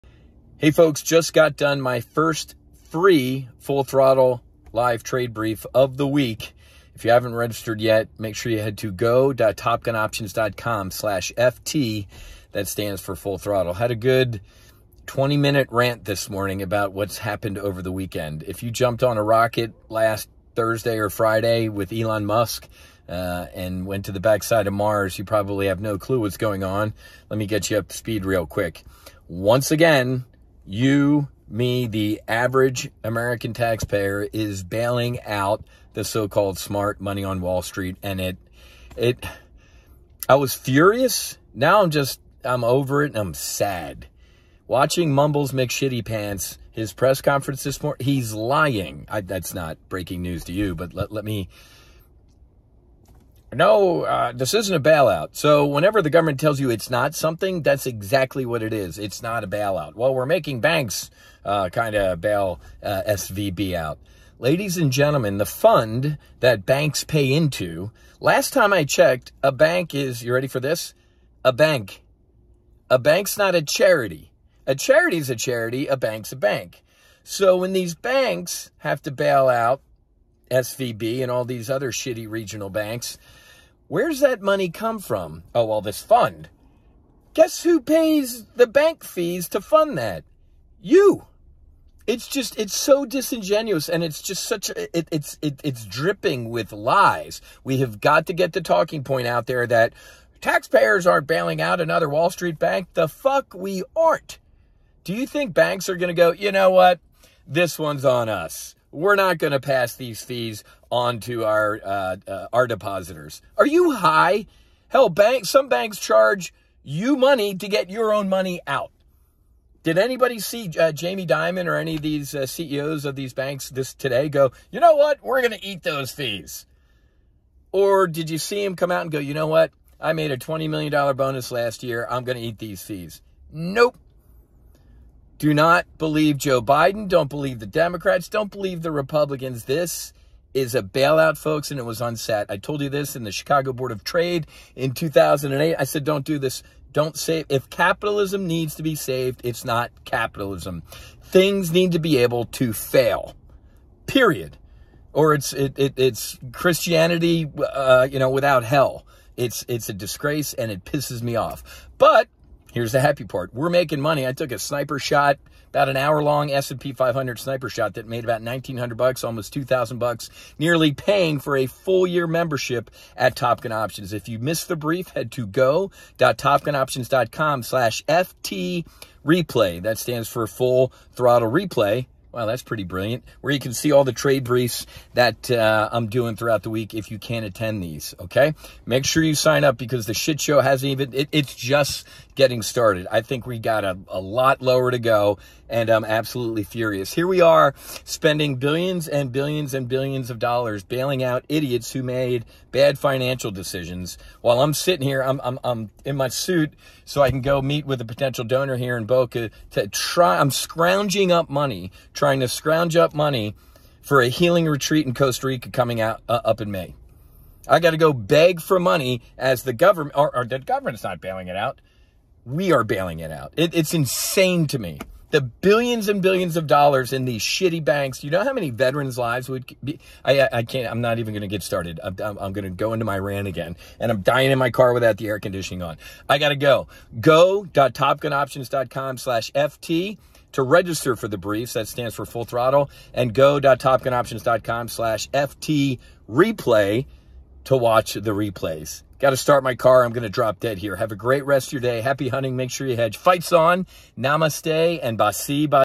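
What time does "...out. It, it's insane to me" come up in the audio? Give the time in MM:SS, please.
03:43.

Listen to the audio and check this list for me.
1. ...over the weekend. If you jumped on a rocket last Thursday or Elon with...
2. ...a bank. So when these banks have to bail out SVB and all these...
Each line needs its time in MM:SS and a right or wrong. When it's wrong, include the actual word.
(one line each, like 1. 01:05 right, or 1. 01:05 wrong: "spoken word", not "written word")
1. 00:17 wrong: "Friday", not "Elon"
2. 01:16 right.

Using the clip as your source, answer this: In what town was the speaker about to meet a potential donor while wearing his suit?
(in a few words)
Boca.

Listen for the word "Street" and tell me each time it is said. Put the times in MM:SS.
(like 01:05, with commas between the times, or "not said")
00:37, 01:42.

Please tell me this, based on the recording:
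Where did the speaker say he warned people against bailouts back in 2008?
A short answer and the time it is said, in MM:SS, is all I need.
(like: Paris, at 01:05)
Chicago Board of Trade, at 02:23.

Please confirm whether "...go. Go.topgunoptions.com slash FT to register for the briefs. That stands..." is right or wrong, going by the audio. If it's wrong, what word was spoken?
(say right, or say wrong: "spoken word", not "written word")
right.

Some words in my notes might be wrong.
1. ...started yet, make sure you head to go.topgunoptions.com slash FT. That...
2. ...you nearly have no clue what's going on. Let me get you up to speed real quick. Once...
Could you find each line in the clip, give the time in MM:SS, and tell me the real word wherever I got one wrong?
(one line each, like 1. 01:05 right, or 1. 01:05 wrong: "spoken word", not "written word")
1. 00:07 wrong: "registered", not "started"
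2. 00:25 wrong: "probably", not "nearly".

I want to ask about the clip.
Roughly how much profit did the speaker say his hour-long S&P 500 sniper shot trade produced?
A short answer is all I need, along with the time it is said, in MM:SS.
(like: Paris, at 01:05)
1900 bucks, at 02:48.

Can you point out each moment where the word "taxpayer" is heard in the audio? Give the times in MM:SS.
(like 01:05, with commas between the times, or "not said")
00:33, 01:40.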